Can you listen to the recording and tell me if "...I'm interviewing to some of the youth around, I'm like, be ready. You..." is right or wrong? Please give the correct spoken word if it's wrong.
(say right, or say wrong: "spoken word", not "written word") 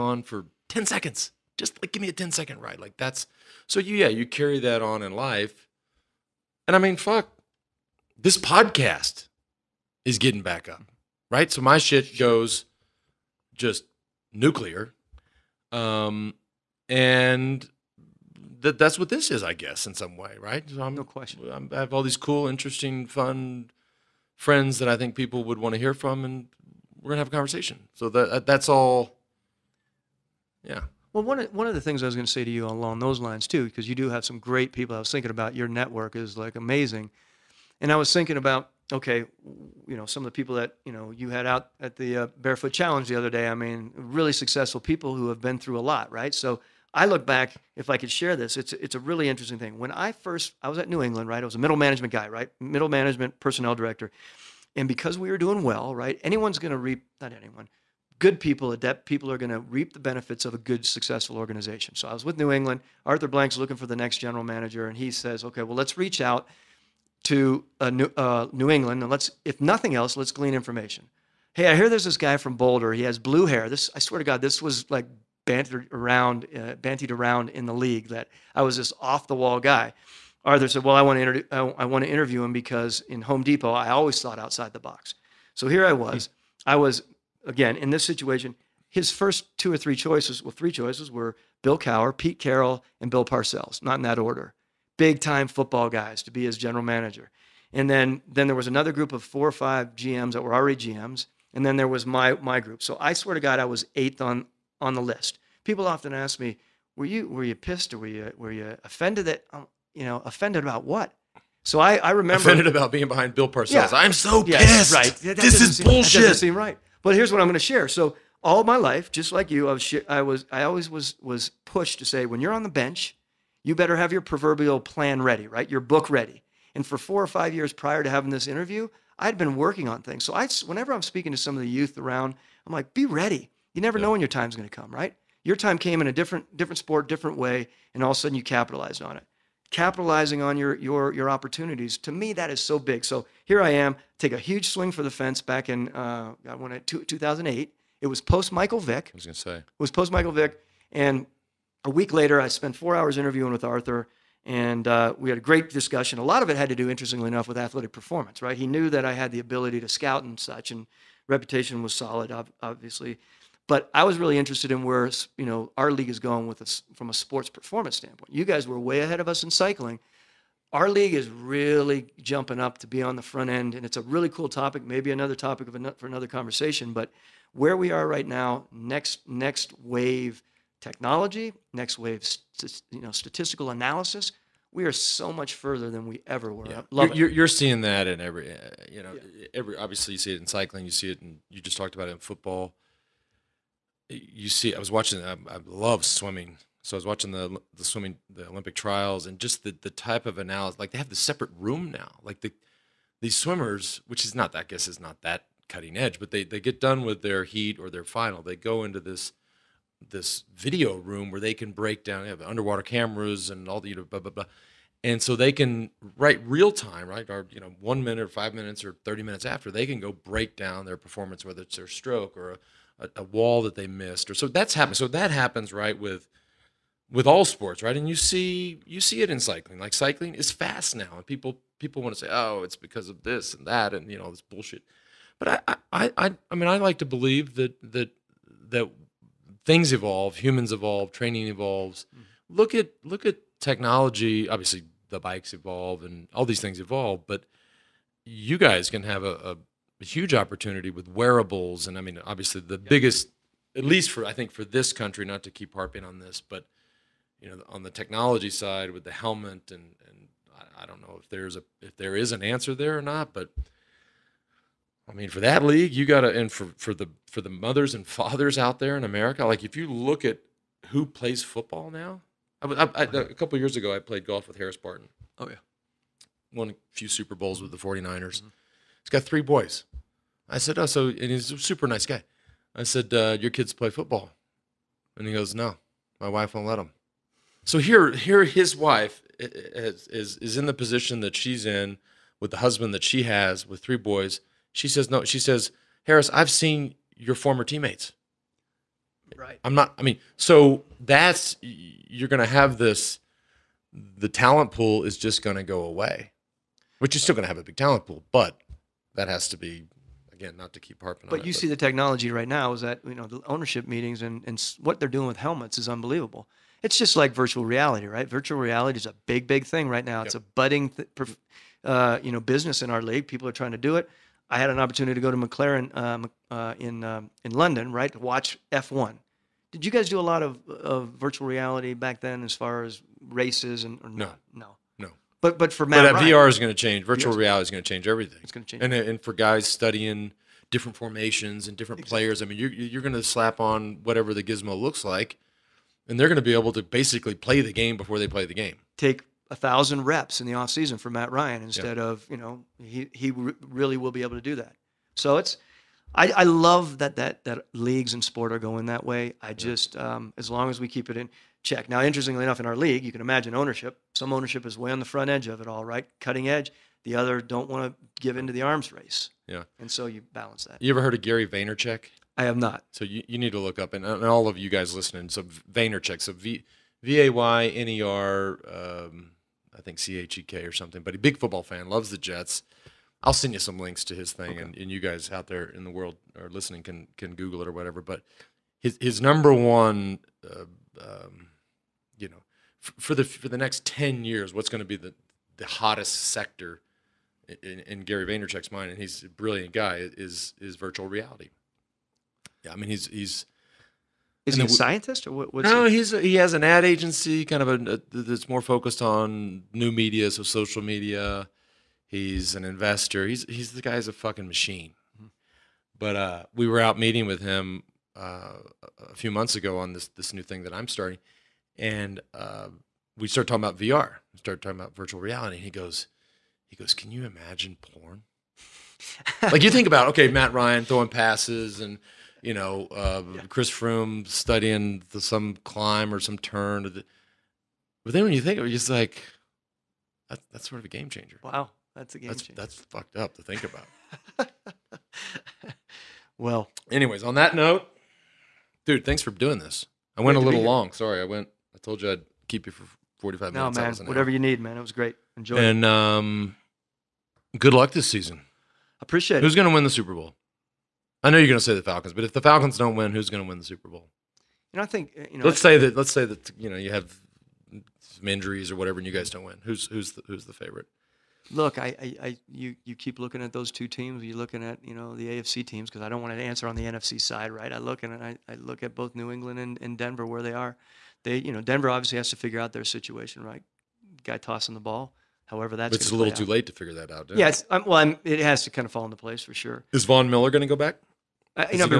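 wrong: "speaking", not "interviewing".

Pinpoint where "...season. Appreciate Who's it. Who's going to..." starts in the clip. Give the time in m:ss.
7:38.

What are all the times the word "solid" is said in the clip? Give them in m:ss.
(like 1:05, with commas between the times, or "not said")
2:41.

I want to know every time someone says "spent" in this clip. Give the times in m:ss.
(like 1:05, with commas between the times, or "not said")
2:32.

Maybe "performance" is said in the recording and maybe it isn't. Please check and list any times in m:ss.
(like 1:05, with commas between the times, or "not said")
2:37, 2:47, 3:40.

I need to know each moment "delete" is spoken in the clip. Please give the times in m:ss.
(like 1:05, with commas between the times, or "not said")
not said.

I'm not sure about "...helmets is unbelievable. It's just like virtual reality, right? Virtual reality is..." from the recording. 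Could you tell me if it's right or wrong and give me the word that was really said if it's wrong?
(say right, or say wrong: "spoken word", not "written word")
right.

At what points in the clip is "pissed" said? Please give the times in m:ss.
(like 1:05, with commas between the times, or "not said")
1:47, 1:54.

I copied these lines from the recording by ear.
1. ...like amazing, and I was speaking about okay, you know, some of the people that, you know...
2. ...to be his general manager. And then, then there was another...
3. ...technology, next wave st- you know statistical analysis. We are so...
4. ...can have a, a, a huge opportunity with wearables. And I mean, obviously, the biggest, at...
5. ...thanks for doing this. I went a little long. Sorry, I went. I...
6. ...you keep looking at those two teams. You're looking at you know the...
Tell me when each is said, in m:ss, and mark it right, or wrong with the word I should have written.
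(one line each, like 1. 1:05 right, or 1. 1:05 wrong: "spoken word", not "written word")
1. 0:36 wrong: "thinking", not "speaking"
2. 1:36 right
3. 3:00 right
4. 4:08 right
5. 7:29 right
6. 7:52 right.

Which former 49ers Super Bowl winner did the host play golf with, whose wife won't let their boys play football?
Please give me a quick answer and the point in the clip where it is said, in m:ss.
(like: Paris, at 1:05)
Harris Barton, at 4:34.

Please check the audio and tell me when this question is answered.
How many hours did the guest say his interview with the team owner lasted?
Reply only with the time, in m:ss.
2:32.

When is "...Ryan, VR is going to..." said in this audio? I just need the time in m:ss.
5:36.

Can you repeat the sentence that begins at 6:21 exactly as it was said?
But a big football fan, loves the Jets.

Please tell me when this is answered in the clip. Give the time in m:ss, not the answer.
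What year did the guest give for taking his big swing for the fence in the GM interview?
2:27.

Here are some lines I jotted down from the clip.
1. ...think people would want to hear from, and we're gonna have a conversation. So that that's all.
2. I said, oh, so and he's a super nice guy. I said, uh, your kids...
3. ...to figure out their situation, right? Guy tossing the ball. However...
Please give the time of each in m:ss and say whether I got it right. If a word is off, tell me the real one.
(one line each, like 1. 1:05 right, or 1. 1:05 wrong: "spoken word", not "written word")
1. 0:24 right
2. 4:40 right
3. 8:02 right.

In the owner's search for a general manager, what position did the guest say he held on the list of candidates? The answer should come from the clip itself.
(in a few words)
Eighth.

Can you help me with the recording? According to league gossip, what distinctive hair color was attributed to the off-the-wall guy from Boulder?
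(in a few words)
Blue.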